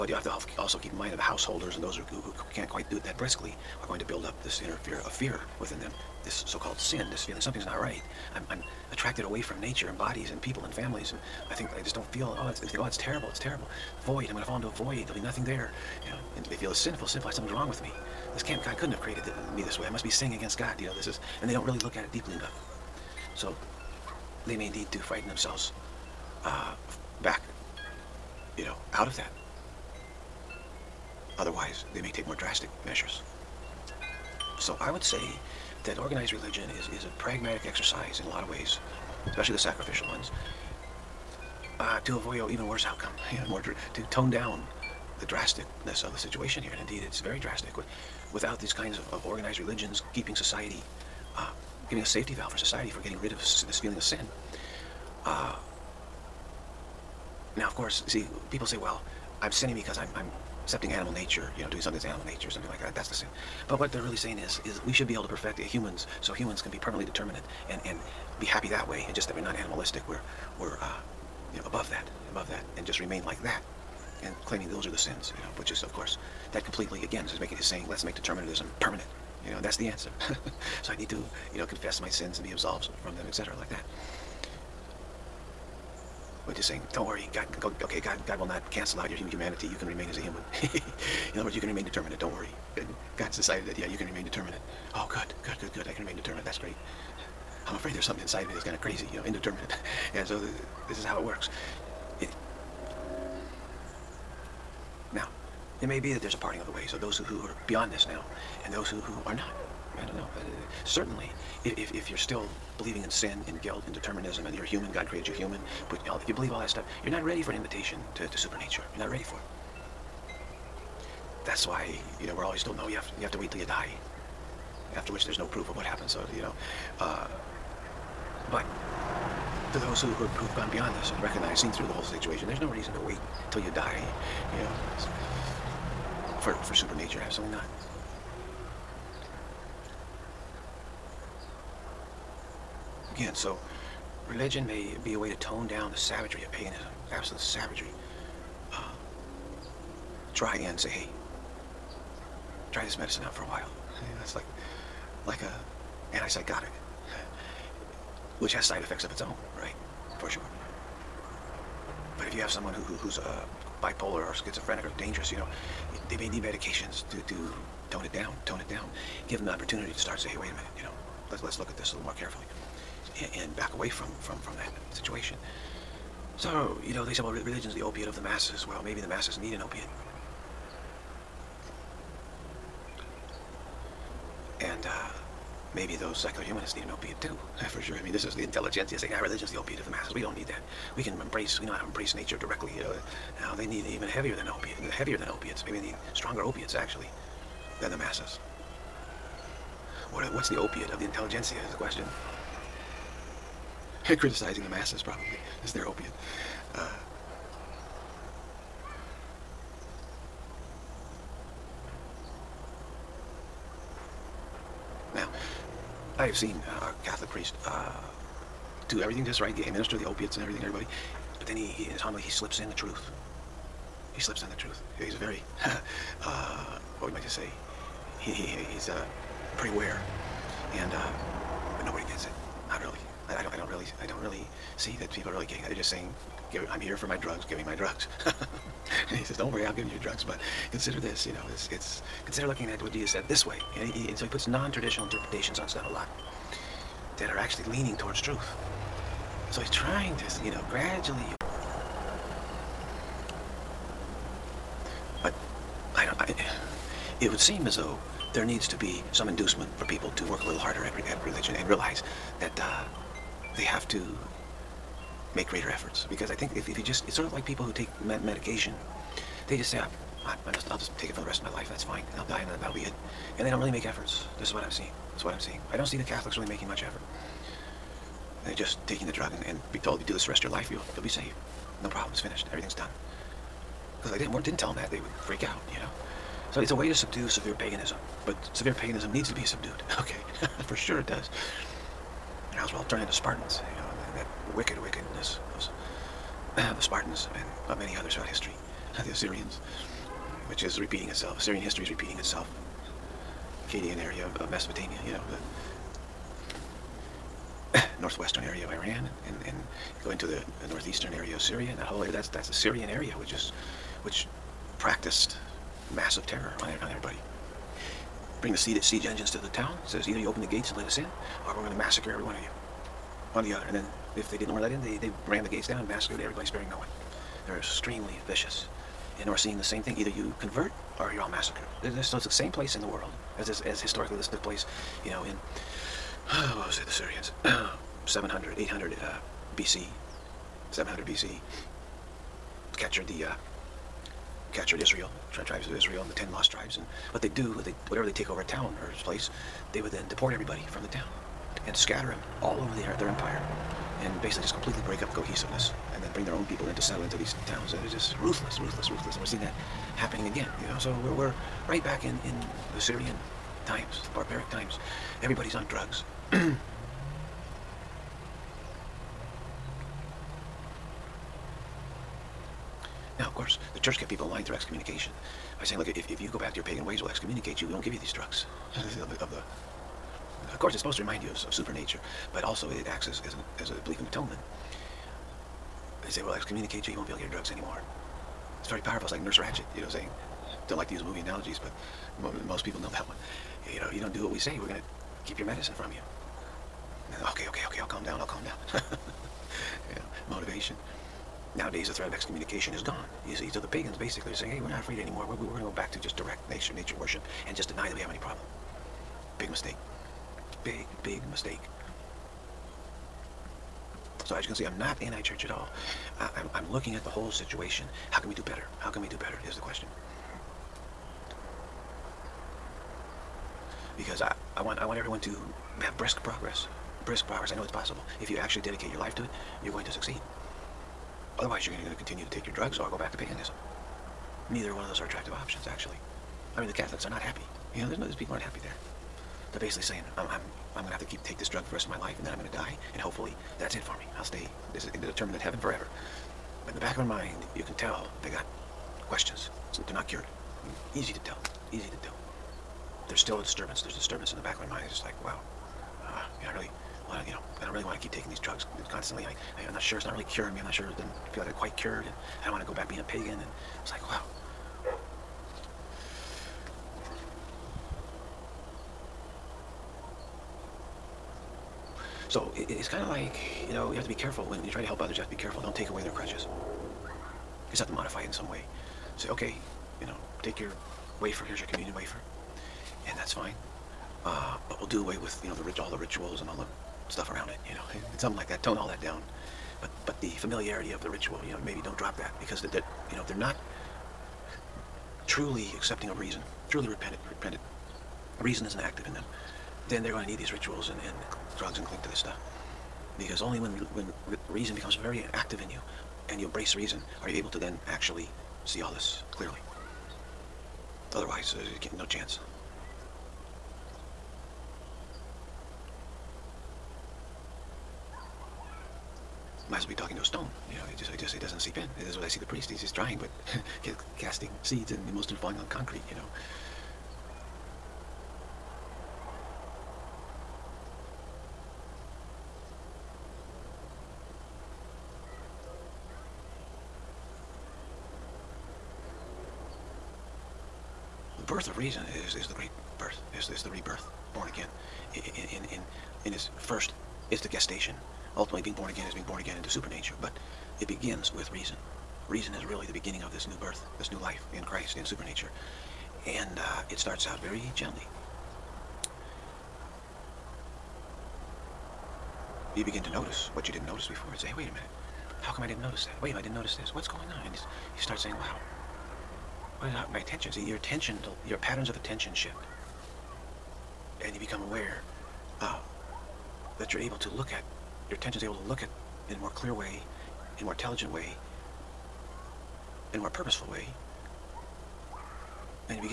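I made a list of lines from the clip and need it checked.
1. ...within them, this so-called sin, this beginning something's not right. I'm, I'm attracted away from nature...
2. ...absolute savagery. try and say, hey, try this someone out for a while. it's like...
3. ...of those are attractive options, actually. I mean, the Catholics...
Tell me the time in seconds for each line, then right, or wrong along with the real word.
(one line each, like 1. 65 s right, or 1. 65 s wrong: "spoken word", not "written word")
1. 5 s wrong: "feeling", not "beginning"
2. 147 s wrong: "medicine", not "someone"
3. 434 s right.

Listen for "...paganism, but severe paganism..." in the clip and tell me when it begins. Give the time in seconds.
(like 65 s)
287 s.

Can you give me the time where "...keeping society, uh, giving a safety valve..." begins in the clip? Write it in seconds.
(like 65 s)
50 s.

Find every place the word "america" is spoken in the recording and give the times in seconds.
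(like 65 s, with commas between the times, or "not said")
not said.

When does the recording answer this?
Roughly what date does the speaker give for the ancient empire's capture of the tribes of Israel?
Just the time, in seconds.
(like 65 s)
340 s.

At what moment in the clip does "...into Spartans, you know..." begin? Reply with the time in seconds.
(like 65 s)
293 s.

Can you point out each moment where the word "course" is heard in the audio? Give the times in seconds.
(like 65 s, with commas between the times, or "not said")
57 s, 75 s, 373 s, 380 s.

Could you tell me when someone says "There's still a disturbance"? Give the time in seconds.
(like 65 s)
453 s.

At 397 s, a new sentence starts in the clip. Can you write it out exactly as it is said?
Then, okay, okay, okay, I'll calm down, I'll calm down.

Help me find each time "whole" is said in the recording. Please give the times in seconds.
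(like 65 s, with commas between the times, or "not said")
131 s, 311 s, 417 s.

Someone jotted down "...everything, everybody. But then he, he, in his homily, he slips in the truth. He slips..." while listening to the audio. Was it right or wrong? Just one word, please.
right.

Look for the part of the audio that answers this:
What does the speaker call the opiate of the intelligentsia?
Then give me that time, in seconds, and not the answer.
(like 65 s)
204 s.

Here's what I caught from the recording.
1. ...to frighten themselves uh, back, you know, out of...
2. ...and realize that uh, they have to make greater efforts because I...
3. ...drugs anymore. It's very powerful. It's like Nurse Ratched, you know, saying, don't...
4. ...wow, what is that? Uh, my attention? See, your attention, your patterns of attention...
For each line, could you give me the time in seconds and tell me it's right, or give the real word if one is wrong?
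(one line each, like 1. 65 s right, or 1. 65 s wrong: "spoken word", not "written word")
1. 24 s right
2. 261 s right
3. 387 s right
4. 568 s right.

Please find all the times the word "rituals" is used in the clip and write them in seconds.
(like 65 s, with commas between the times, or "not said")
485 s, 491 s, 500 s.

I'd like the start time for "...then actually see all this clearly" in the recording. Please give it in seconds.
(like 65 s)
507 s.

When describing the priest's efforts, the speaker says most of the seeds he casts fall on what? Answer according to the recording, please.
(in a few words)
Concrete.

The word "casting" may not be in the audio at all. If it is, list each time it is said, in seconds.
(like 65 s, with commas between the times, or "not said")
524 s.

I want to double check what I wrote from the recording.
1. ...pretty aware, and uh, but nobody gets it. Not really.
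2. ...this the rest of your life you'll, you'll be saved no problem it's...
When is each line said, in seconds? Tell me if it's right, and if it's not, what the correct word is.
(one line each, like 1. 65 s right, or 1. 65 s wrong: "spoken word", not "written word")
1. 229 s right
2. 280 s right.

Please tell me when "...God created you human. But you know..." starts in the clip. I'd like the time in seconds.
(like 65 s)
114 s.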